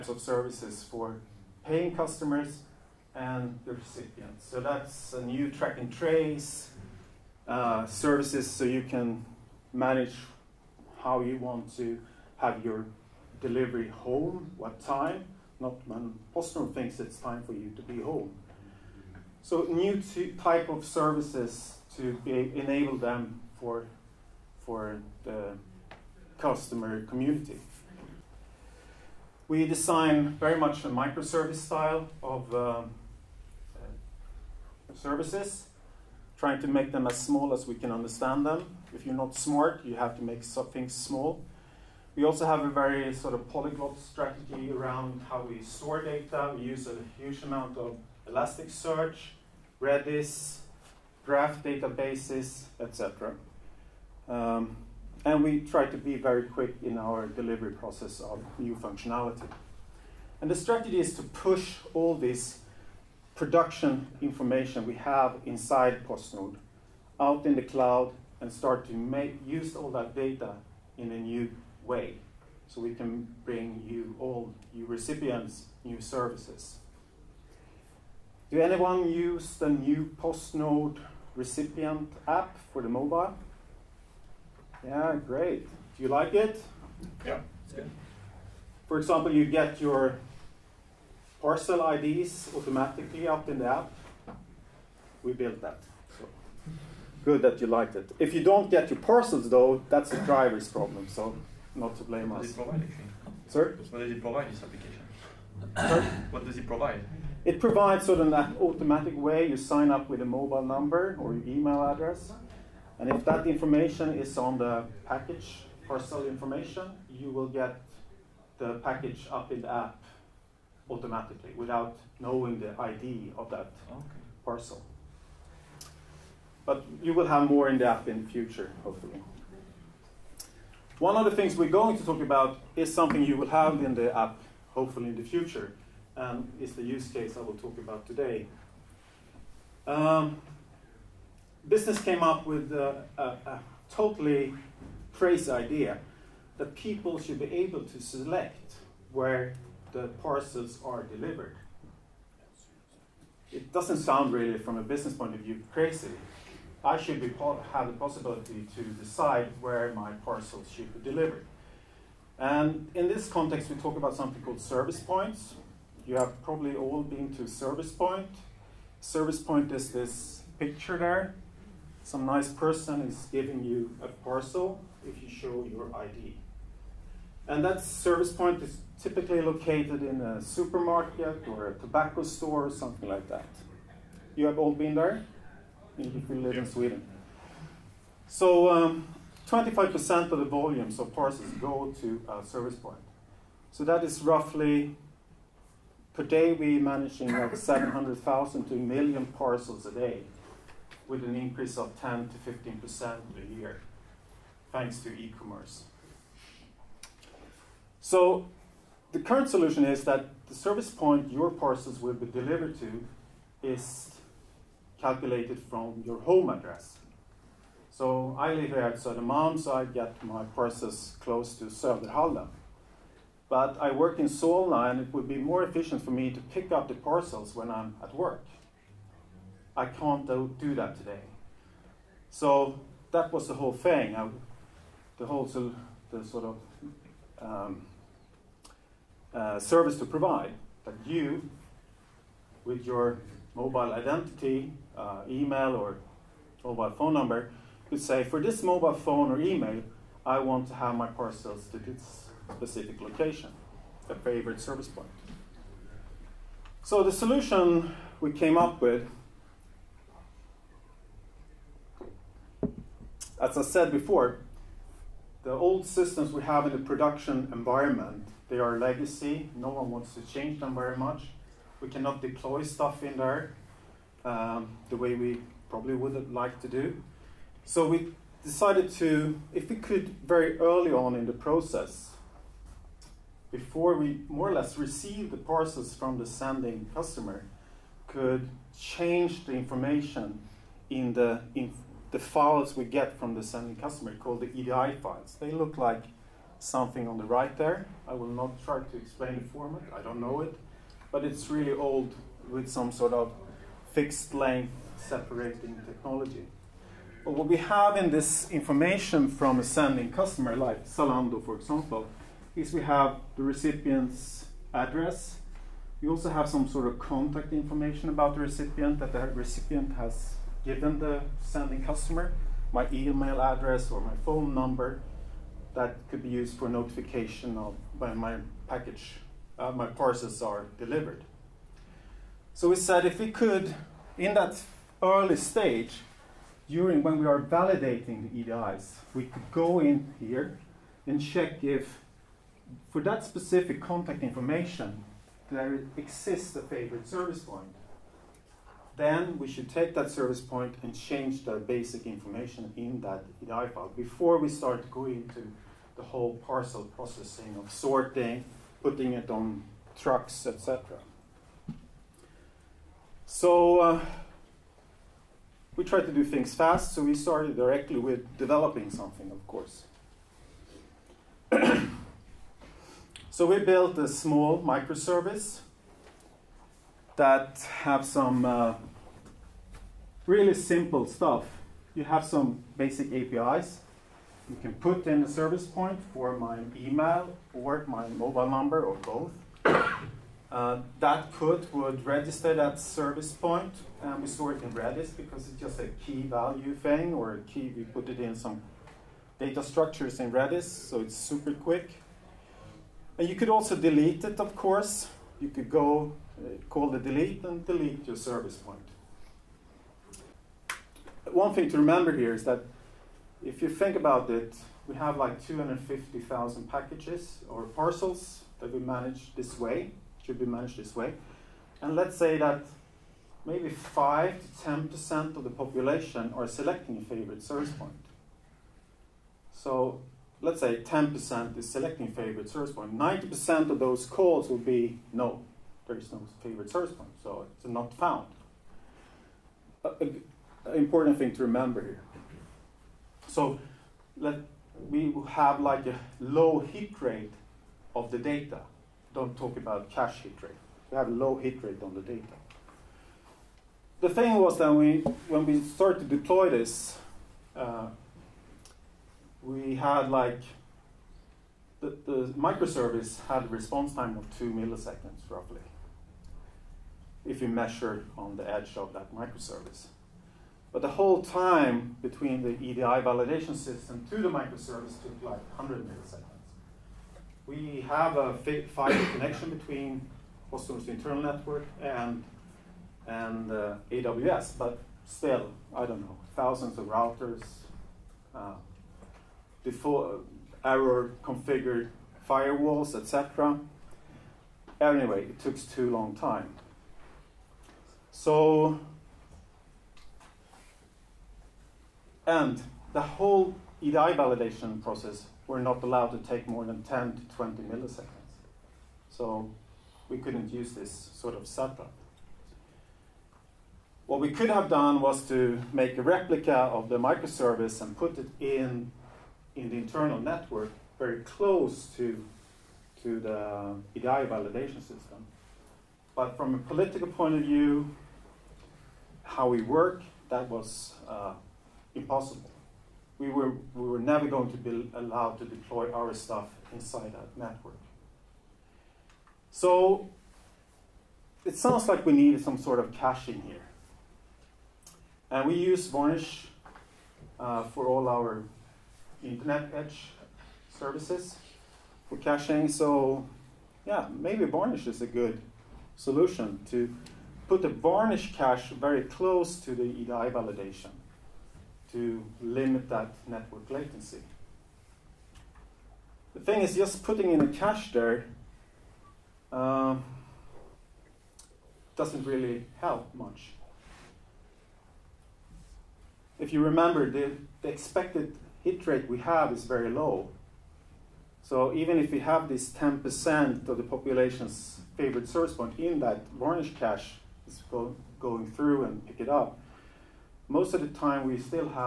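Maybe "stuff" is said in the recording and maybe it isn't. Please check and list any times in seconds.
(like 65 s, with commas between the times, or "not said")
272 s, 381 s, 536 s.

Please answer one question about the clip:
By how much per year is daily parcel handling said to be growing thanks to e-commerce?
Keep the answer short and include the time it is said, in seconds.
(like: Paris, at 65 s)
10 to 15%, at 201 s.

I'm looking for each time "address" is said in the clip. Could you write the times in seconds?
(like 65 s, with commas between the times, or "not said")
111 s, 216 s, 314 s, 323 s.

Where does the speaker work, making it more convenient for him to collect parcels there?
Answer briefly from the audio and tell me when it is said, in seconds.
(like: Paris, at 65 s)
Solna, at 224 s.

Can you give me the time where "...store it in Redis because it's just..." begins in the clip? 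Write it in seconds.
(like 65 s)
394 s.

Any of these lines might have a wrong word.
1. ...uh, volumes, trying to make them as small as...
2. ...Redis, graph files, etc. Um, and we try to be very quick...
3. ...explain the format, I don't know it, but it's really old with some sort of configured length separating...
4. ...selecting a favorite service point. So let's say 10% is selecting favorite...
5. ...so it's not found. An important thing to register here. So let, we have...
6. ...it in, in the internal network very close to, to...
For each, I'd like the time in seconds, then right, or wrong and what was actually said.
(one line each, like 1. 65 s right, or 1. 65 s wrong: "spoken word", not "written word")
1. 32 s wrong: "services", not "volumes"
2. 49 s wrong: "databases", not "files"
3. 298 s wrong: "fixed", not "configured"
4. 426 s right
5. 437 s wrong: "remember", not "register"
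6. 518 s right.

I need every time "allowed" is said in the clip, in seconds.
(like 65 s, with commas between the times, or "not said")
505 s, 534 s.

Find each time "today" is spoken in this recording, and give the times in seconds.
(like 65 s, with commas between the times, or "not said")
138 s, 230 s.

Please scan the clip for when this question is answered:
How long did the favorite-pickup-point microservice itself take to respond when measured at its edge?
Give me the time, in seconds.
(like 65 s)
464 s.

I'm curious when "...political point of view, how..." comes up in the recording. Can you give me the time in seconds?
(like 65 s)
526 s.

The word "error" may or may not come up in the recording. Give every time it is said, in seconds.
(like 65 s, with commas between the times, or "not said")
490 s.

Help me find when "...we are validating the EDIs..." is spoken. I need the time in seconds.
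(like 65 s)
337 s.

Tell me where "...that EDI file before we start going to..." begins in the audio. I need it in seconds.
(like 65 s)
353 s.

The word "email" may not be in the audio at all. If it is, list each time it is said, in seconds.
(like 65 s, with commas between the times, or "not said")
111 s, 245 s, 249 s, 322 s, 386 s.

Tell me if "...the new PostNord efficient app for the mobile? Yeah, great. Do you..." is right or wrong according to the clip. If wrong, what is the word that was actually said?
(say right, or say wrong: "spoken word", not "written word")
wrong: "recipient", not "efficient".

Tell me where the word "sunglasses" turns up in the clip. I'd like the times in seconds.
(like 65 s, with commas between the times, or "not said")
not said.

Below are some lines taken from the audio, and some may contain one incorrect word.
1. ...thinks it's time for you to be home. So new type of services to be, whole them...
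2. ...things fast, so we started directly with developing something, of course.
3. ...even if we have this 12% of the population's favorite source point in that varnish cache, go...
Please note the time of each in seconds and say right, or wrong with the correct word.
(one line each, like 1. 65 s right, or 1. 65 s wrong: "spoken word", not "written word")
1. 16 s wrong: "enable", not "whole"
2. 366 s right
3. 581 s wrong: "10", not "12".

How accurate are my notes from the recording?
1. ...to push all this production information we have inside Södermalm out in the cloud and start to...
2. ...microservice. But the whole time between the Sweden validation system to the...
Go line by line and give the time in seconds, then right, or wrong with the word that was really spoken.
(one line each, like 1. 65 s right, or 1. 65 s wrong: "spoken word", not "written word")
1. 61 s wrong: "PostNord", not "Södermalm"
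2. 469 s wrong: "EDI", not "Sweden".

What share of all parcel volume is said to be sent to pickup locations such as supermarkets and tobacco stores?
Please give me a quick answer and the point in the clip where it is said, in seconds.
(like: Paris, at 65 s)
25%, at 189 s.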